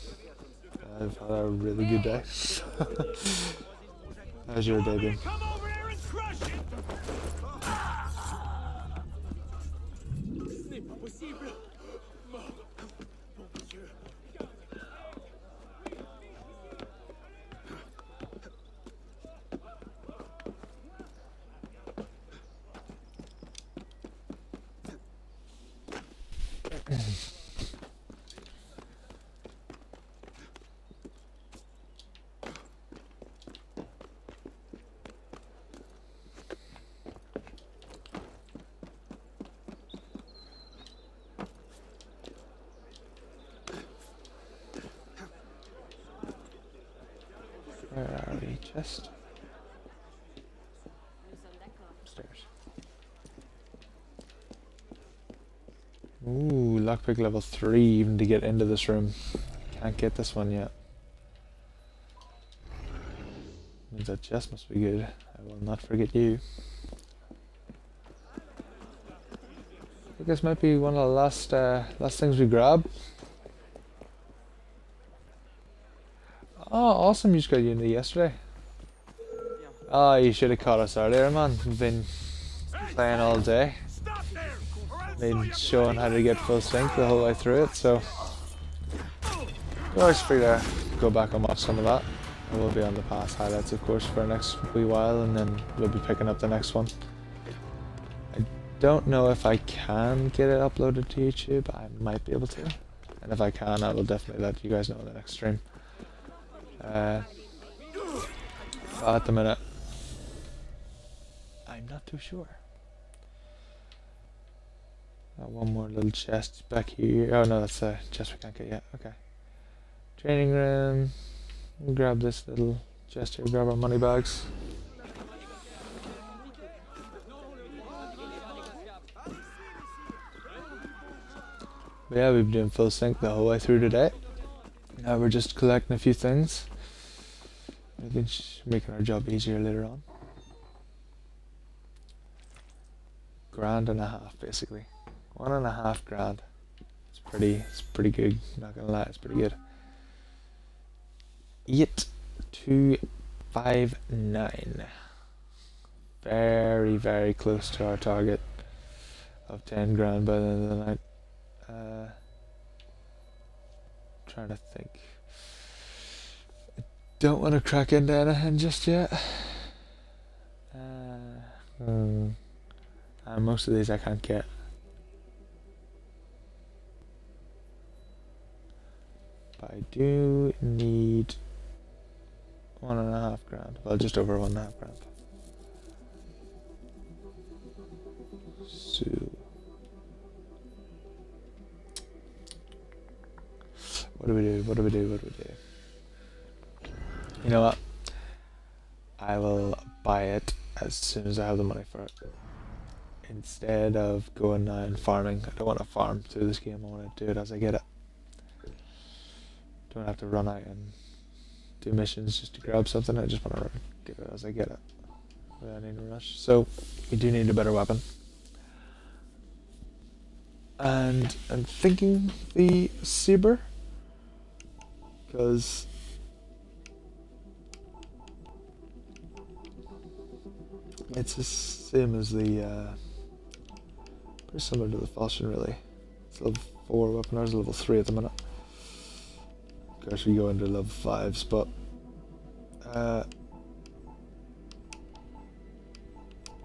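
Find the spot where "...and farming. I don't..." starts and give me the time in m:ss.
3:24.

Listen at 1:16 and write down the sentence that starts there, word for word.
awesome you just got knee yesterday.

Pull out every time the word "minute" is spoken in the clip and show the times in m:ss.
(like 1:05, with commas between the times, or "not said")
1:49, 3:58.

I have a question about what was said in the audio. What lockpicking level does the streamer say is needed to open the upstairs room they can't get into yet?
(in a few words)
Level 3.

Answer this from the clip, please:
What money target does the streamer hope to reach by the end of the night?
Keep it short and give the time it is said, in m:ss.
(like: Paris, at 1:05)
10 grand, at 2:39.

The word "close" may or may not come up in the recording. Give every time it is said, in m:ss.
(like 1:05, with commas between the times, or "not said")
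2:37.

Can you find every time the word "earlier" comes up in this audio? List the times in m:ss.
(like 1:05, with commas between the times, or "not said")
1:20.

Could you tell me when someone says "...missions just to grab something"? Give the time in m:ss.
3:31.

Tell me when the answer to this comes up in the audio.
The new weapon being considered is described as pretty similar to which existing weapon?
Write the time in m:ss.
3:55.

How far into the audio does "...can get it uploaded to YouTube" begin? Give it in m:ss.
1:39.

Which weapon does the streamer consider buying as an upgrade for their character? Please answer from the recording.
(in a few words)
Saber.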